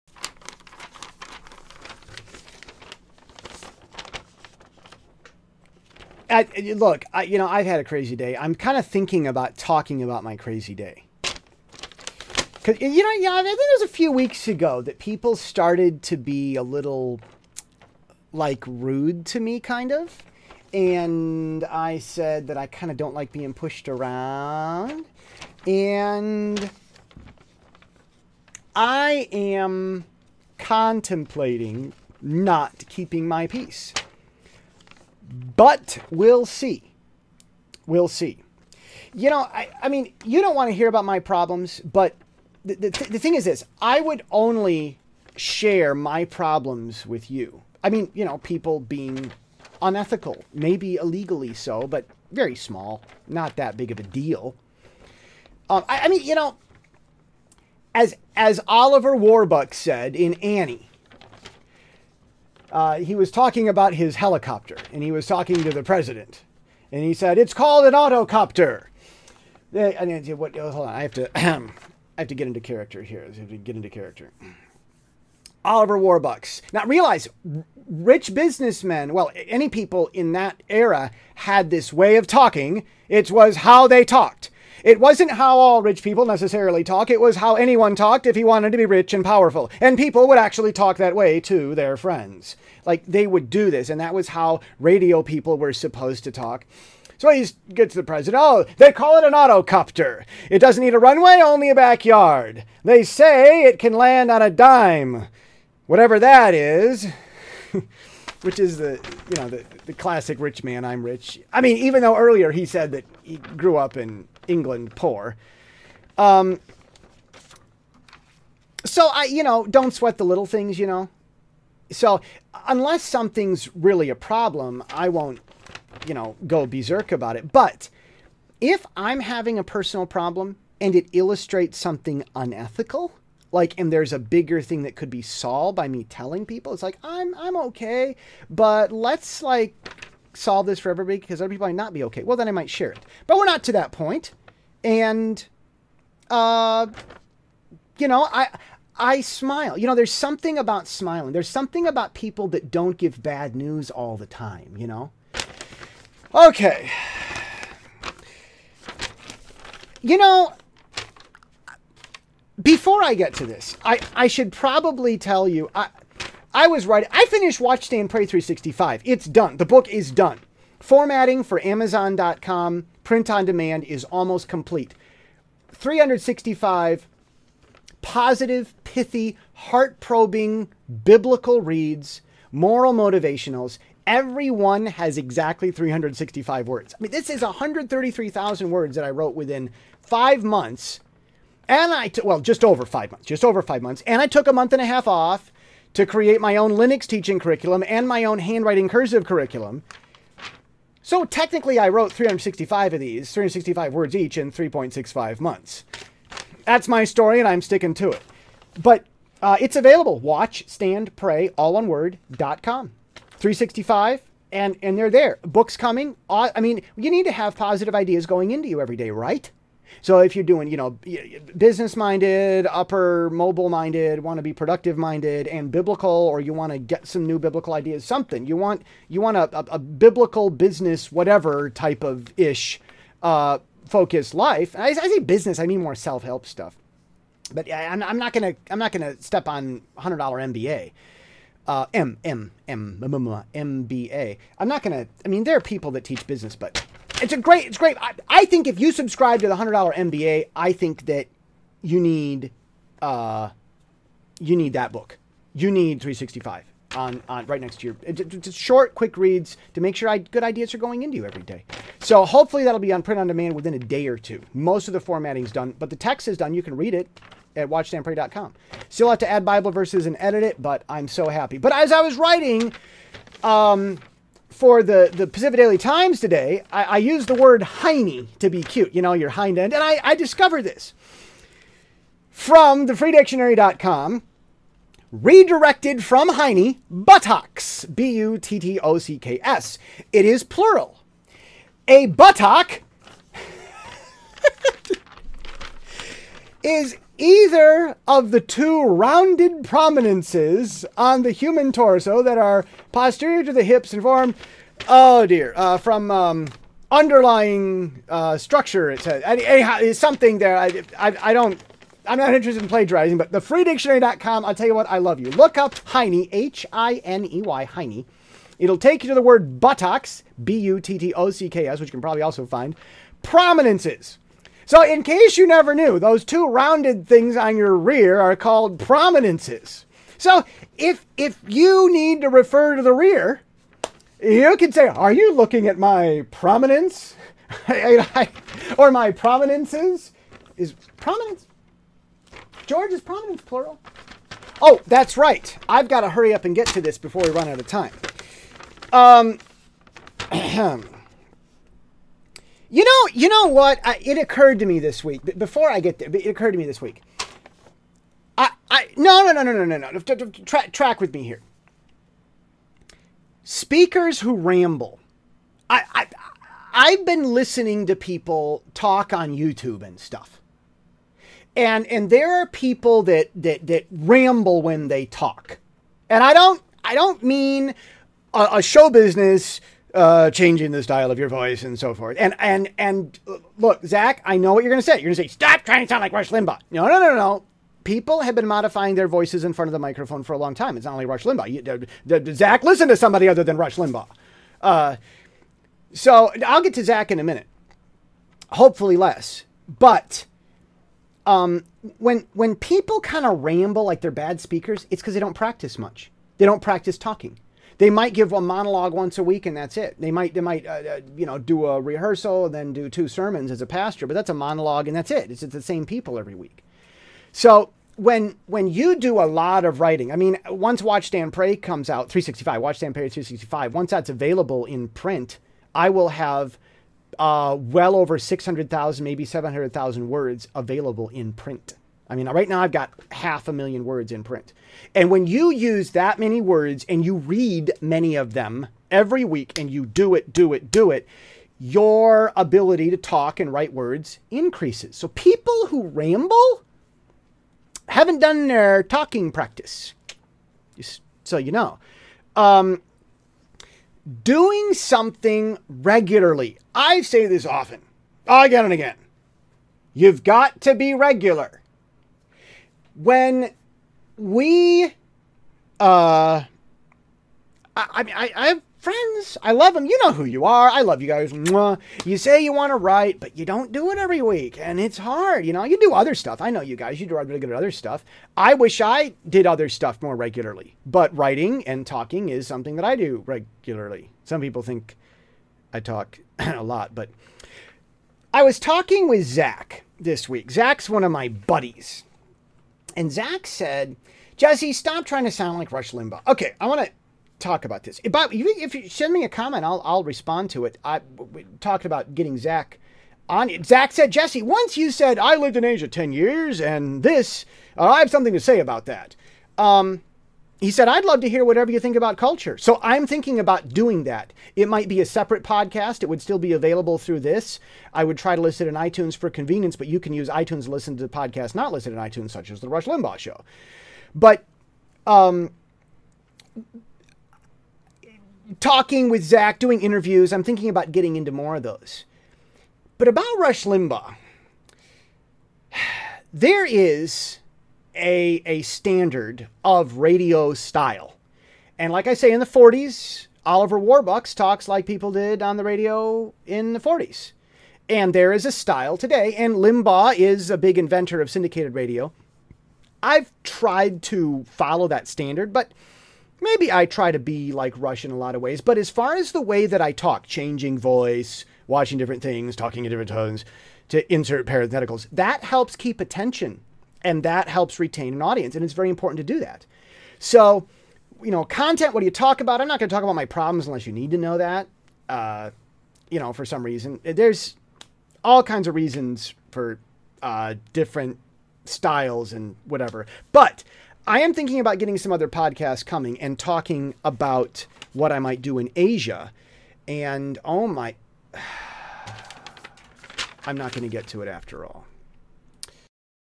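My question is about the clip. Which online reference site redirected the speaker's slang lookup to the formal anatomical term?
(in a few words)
thefreedictionary.com.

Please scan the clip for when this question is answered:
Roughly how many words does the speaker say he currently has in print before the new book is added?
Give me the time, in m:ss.
7:13.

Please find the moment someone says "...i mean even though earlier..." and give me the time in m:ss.
1:51.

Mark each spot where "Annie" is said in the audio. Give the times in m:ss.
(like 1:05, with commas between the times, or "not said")
1:00.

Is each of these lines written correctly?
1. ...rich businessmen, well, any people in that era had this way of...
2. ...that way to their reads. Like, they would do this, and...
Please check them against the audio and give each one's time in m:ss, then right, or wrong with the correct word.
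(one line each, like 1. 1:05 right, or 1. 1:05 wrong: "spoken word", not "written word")
1. 1:17 right
2. 1:30 wrong: "friends", not "reads".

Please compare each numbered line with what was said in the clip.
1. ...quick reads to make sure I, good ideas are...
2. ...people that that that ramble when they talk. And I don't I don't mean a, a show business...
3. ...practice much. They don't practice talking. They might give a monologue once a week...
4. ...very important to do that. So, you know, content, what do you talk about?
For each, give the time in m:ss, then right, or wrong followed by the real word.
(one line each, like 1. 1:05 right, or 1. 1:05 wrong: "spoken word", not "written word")
1. 4:18 right
2. 6:12 right
3. 6:45 right
4. 9:28 right.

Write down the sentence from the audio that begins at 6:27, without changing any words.
People have been modifying their voices in front of the microphone for a long time.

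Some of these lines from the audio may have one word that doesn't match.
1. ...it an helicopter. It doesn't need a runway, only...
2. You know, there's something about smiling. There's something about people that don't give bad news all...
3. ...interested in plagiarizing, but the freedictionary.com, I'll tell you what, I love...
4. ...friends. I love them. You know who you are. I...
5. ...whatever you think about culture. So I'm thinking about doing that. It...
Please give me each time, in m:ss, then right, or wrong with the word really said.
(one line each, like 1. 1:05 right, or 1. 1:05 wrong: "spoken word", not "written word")
1. 1:39 wrong: "autocopter", not "helicopter"
2. 2:29 right
3. 5:12 right
4. 7:48 right
5. 8:31 right.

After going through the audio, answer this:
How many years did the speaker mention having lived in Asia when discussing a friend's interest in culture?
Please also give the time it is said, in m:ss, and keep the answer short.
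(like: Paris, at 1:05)
10, at 8:25.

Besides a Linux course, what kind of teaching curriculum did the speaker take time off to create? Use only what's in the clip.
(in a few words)
handwriting cursive curriculum.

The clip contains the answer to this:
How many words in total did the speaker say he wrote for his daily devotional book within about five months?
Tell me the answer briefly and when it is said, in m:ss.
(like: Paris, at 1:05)
133,000, at 3:07.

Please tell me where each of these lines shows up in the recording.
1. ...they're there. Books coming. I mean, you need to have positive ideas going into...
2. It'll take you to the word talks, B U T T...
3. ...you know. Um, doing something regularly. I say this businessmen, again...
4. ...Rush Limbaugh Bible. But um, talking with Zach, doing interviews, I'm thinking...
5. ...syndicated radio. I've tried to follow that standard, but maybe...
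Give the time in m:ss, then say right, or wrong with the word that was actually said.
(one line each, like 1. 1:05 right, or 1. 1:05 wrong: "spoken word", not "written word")
1. 3:34 right
2. 5:18 wrong: "buttocks", not "talks"
3. 7:31 wrong: "often", not "businessmen"
4. 8:42 wrong: "Show", not "Bible"
5. 9:11 right.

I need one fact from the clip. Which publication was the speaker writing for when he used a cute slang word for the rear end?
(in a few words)
Pacific Daily Times.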